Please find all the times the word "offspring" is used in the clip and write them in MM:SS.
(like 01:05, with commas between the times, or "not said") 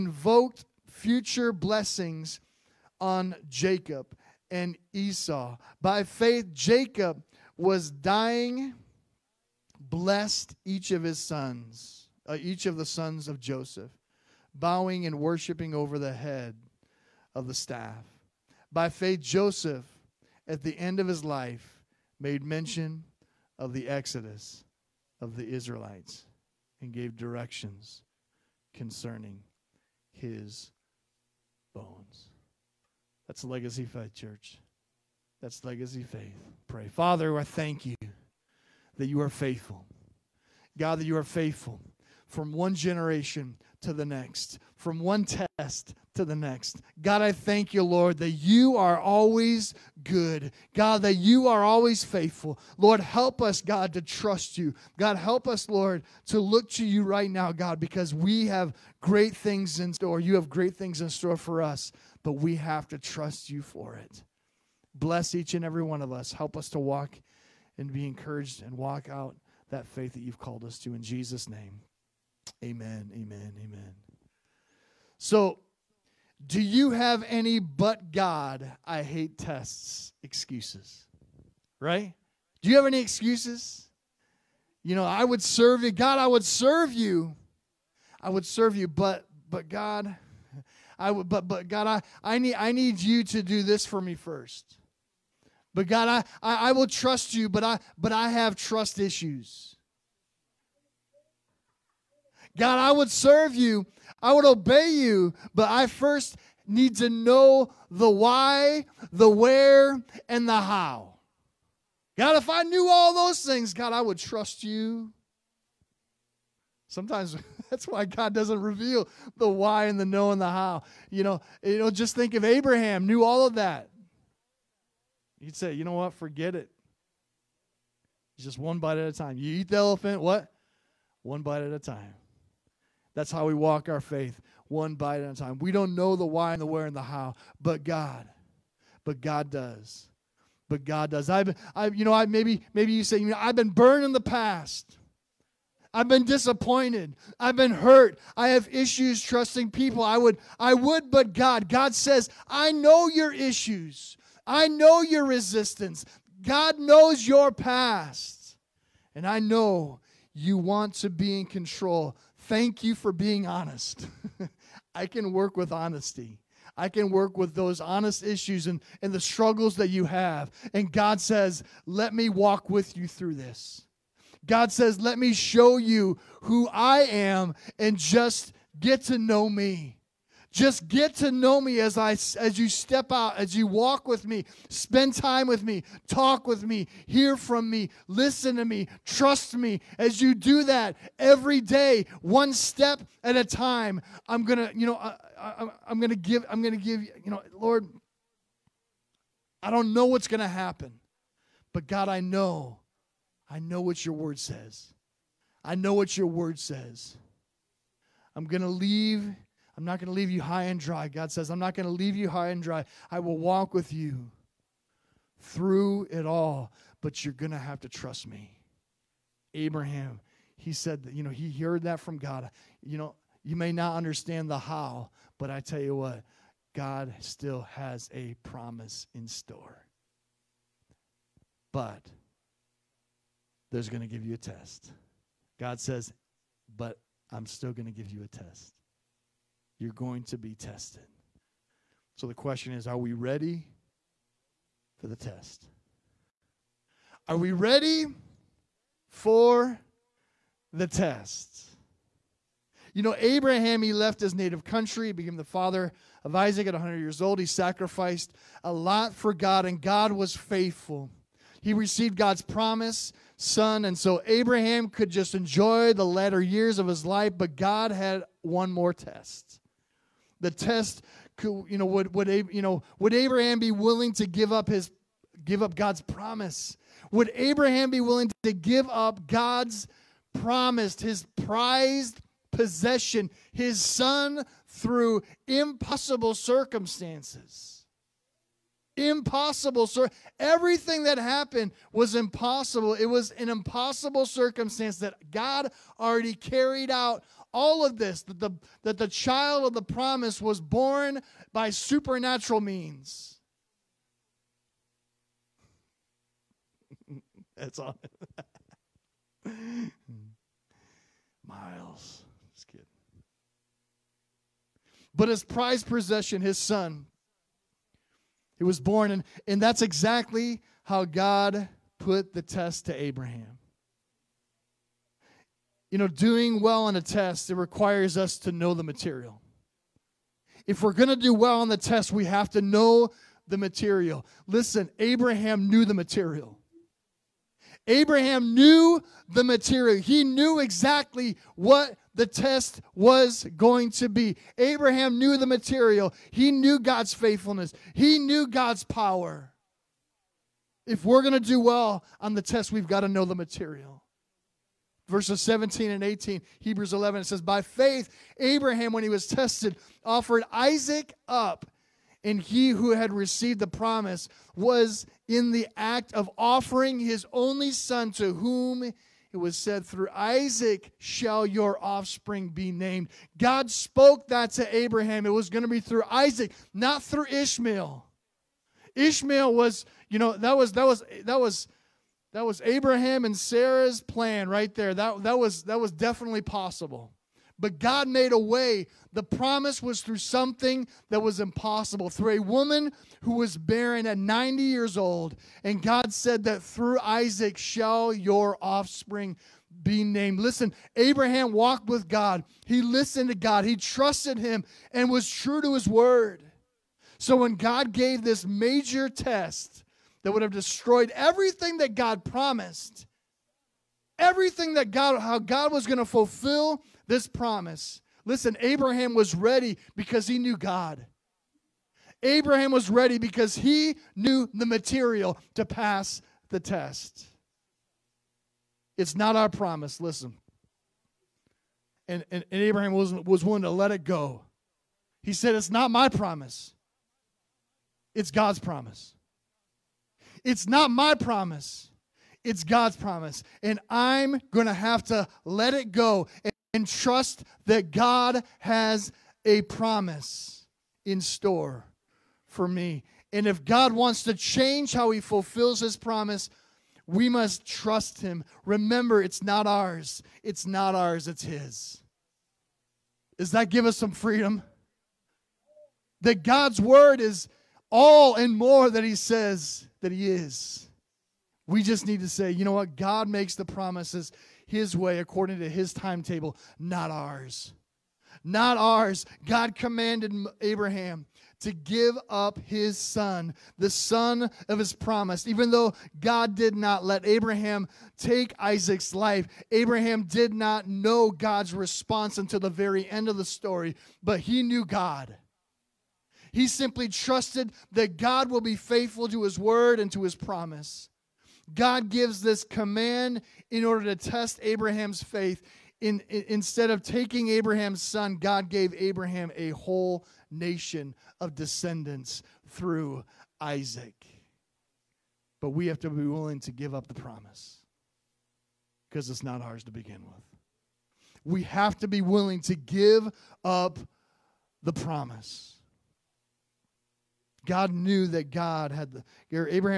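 06:11, 06:38.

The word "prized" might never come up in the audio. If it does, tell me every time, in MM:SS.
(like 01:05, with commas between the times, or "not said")
04:41, 05:15.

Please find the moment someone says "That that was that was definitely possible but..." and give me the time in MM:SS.
06:24.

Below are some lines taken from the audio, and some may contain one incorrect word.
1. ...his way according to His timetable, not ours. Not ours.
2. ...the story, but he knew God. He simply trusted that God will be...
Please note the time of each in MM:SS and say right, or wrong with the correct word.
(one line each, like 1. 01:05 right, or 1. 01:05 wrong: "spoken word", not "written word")
1. 07:54 right
2. 08:13 right.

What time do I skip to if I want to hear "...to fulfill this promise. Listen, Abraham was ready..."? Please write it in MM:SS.
06:55.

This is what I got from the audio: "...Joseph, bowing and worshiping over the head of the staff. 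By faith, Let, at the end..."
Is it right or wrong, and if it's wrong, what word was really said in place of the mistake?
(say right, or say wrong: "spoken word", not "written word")
wrong: "Joseph", not "Let".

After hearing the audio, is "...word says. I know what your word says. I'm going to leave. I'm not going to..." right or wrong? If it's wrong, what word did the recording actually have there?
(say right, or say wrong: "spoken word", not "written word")
right.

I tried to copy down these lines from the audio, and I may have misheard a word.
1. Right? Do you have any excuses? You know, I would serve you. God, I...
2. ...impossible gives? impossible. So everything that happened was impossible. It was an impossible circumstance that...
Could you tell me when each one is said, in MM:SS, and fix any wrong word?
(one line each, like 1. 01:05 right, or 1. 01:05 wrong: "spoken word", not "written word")
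1. 01:21 right
2. 04:45 wrong: "circumstances", not "gives".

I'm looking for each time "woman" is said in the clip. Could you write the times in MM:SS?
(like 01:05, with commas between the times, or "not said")
06:32.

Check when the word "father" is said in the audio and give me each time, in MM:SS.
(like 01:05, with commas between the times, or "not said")
00:36, 04:15.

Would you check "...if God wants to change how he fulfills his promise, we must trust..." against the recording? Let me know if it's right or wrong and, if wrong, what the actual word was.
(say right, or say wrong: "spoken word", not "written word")
right.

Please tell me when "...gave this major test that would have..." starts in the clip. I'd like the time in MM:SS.
06:47.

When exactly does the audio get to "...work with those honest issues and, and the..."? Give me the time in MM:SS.
02:47.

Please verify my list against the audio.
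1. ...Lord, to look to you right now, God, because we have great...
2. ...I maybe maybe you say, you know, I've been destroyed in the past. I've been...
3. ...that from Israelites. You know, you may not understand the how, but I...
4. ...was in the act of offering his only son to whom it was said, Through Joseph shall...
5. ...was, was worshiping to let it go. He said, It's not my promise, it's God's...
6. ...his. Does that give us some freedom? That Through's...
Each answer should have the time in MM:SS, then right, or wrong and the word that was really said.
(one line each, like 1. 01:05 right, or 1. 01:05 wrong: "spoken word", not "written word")
1. 00:55 right
2. 02:22 wrong: "burned", not "destroyed"
3. 03:41 wrong: "God", not "Israelites"
4. 06:04 wrong: "Isaac", not "Joseph"
5. 07:12 wrong: "willing", not "worshiping"
6. 07:41 wrong: "God", not "Through".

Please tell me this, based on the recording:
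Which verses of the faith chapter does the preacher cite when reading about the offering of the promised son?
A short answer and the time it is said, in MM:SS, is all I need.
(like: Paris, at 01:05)
17 and 18, at 05:55.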